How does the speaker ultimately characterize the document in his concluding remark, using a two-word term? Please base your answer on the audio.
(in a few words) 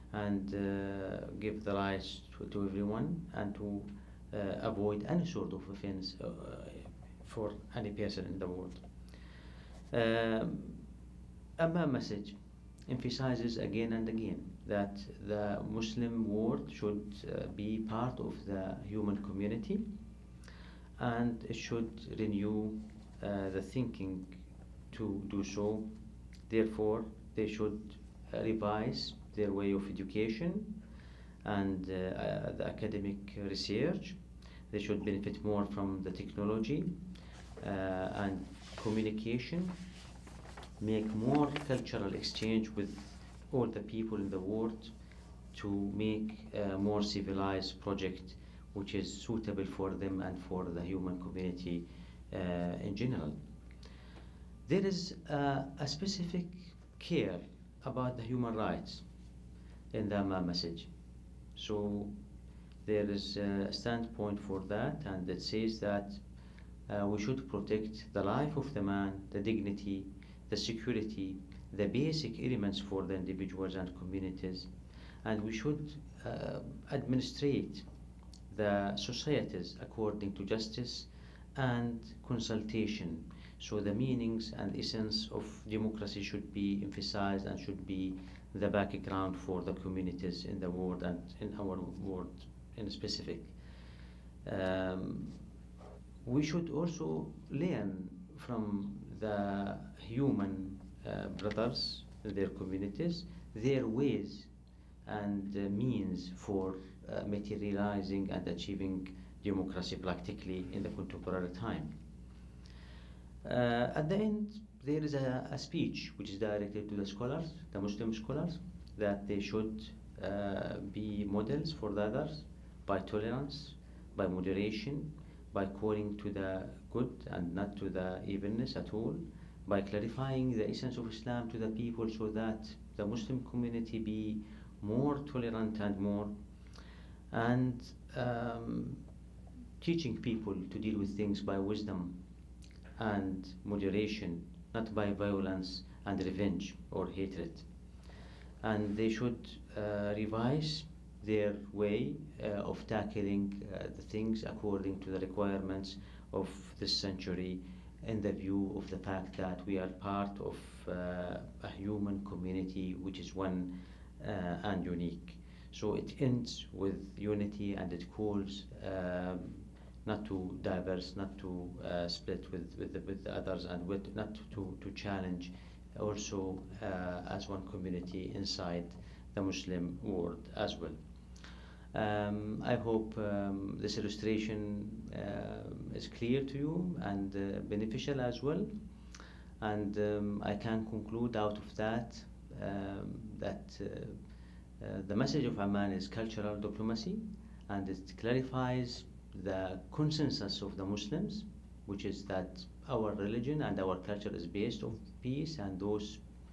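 Cultural diplomacy.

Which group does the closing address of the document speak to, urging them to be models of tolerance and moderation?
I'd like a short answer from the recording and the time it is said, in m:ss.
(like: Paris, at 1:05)
Muslim scholars, at 1:57.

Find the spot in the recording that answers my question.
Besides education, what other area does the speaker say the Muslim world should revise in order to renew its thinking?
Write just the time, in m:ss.
0:32.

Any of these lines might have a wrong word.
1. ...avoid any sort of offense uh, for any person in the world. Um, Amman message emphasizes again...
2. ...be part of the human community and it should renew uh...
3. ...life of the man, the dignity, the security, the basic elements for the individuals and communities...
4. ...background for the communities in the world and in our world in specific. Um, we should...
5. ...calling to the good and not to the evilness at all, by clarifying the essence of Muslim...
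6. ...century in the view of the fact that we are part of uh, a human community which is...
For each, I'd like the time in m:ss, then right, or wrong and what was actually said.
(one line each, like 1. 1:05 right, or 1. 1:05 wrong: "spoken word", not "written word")
1. 0:04 right
2. 0:17 right
3. 1:08 right
4. 1:28 right
5. 2:05 wrong: "Islam", not "Muslim"
6. 2:36 right.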